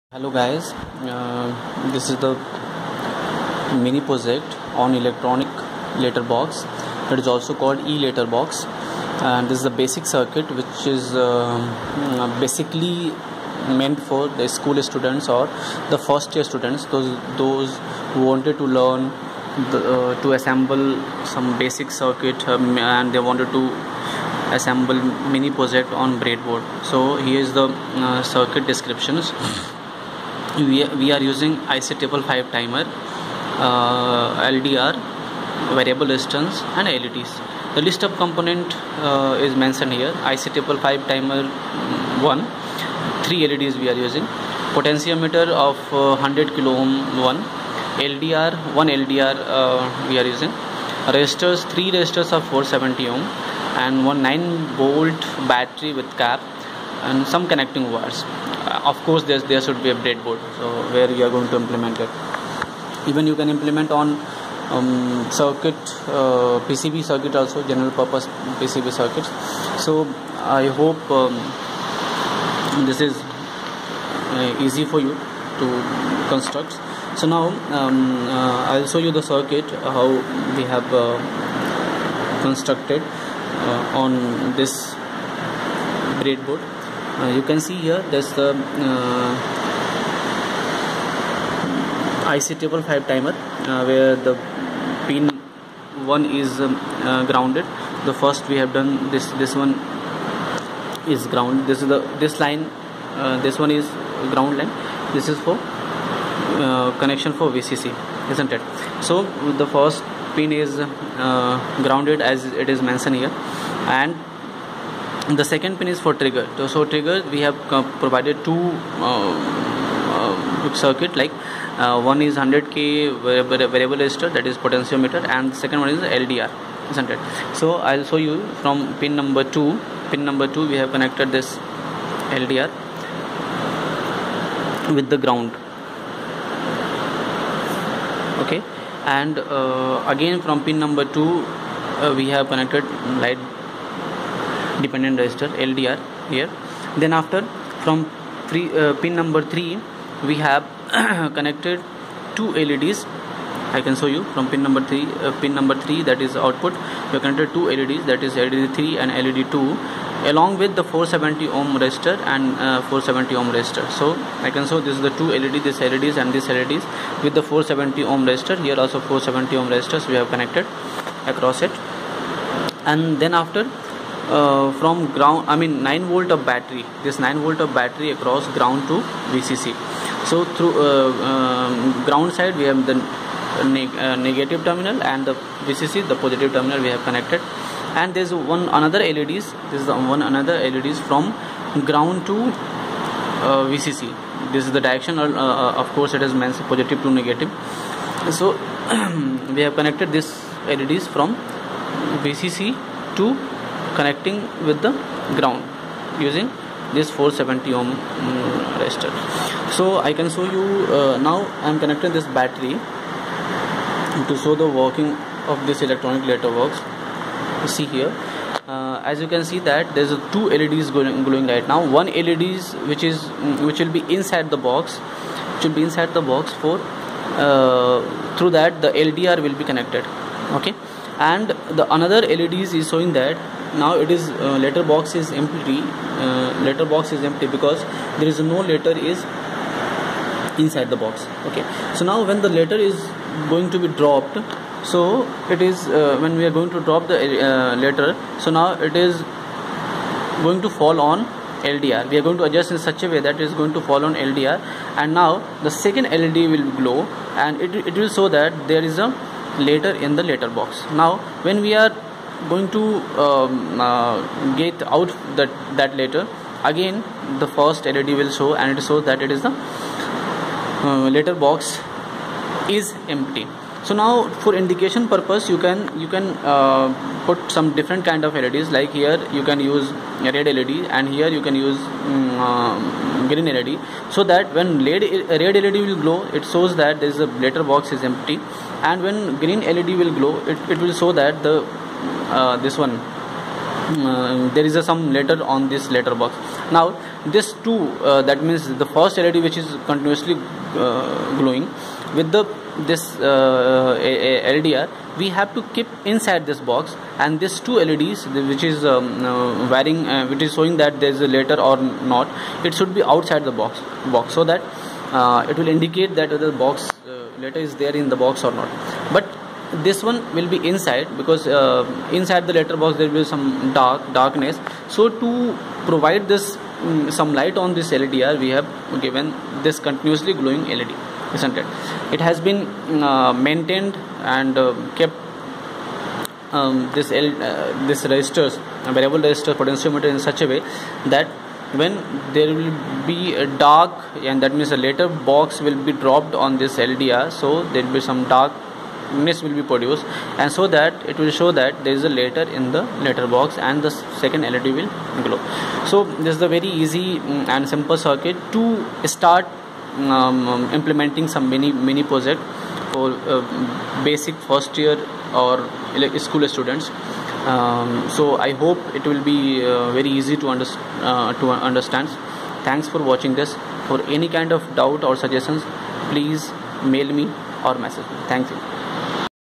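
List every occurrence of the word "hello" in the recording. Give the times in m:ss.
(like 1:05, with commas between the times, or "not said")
0:00.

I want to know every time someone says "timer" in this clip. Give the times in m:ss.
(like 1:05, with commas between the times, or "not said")
0:32, 0:41, 1:33.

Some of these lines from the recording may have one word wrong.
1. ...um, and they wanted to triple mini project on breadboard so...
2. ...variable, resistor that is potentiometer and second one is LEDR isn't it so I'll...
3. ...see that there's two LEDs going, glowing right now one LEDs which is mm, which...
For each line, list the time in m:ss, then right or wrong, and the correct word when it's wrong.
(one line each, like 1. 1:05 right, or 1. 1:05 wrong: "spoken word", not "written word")
1. 0:22 wrong: "assemble", not "triple"
2. 2:03 wrong: "LDR", not "LEDR"
3. 3:39 right.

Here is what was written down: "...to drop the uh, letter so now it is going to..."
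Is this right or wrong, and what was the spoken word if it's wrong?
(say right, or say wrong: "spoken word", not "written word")
right.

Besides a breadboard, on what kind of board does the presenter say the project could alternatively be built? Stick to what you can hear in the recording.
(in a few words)
general purpose PCB.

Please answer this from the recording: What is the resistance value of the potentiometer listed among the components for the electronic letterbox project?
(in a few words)
100 kilo ohm.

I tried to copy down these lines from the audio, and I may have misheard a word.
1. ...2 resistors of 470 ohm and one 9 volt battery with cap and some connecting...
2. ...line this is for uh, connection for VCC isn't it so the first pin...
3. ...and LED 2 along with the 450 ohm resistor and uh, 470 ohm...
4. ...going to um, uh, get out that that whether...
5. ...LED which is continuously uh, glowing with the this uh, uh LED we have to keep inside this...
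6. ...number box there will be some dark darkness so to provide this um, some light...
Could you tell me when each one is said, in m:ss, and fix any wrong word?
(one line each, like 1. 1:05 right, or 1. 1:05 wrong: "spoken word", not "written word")
1. 0:51 wrong: "3", not "2"
2. 1:44 right
3. 2:38 wrong: "470", not "450"
4. 4:22 wrong: "later", not "whether"
5. 4:59 wrong: "LDR", not "LED"
6. 5:22 wrong: "letter", not "number".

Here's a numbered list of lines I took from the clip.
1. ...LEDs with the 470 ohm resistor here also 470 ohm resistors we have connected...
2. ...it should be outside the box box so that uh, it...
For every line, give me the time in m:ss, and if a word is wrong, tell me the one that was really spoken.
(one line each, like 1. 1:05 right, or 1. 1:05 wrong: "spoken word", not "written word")
1. 2:46 right
2. 5:12 right.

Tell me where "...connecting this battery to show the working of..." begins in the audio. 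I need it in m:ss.
3:31.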